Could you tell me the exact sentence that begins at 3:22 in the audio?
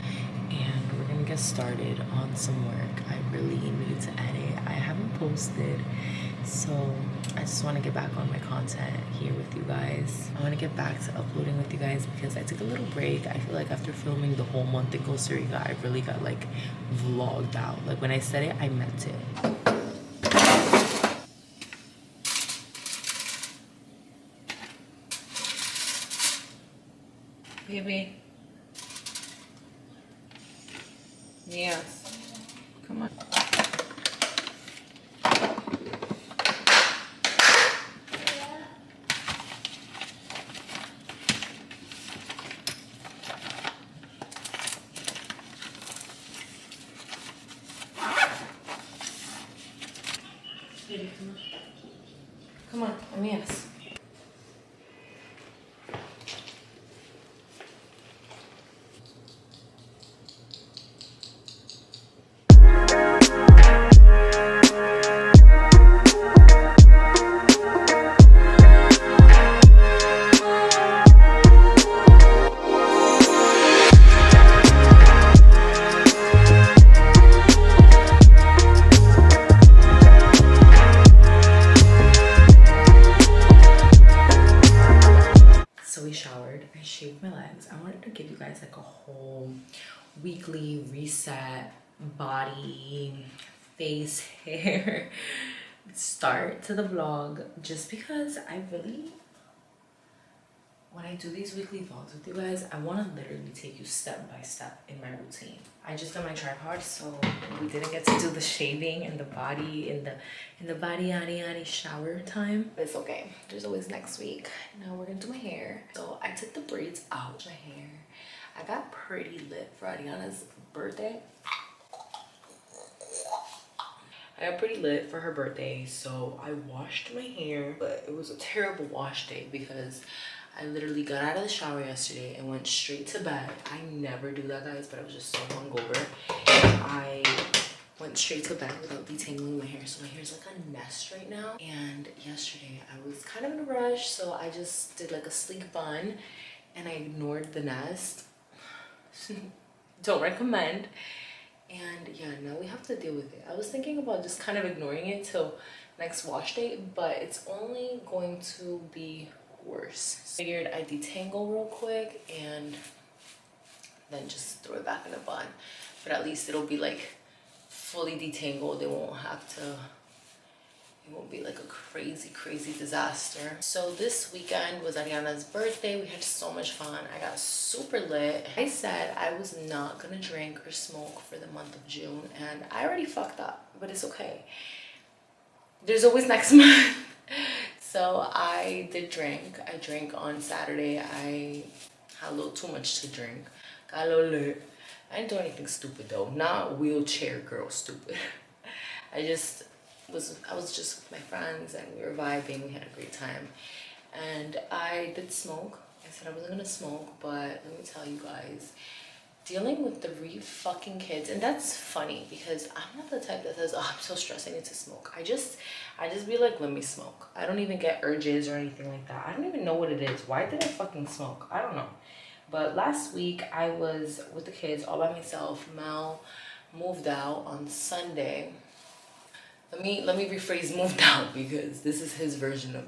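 We had a great time, and I did smoke.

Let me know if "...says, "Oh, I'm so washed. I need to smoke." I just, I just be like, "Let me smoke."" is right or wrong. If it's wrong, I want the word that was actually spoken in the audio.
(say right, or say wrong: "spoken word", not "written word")
wrong: "stressed", not "washed".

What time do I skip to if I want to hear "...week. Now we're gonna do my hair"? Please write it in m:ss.
1:54.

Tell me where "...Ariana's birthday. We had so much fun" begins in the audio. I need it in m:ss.
2:54.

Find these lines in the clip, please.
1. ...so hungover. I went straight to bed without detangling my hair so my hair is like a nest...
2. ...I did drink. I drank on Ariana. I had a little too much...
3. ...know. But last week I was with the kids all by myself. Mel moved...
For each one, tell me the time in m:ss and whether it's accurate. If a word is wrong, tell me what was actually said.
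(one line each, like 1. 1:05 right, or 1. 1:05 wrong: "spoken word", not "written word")
1. 2:15 right
2. 3:08 wrong: "Saturday", not "Ariana"
3. 3:41 right.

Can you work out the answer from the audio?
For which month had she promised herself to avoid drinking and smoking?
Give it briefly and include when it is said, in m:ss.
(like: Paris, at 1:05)
June, at 3:01.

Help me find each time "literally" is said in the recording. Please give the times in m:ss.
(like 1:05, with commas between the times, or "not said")
1:43, 2:10.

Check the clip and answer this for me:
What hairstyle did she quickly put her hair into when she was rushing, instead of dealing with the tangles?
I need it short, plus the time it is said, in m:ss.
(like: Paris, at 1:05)
sleek bun, at 2:25.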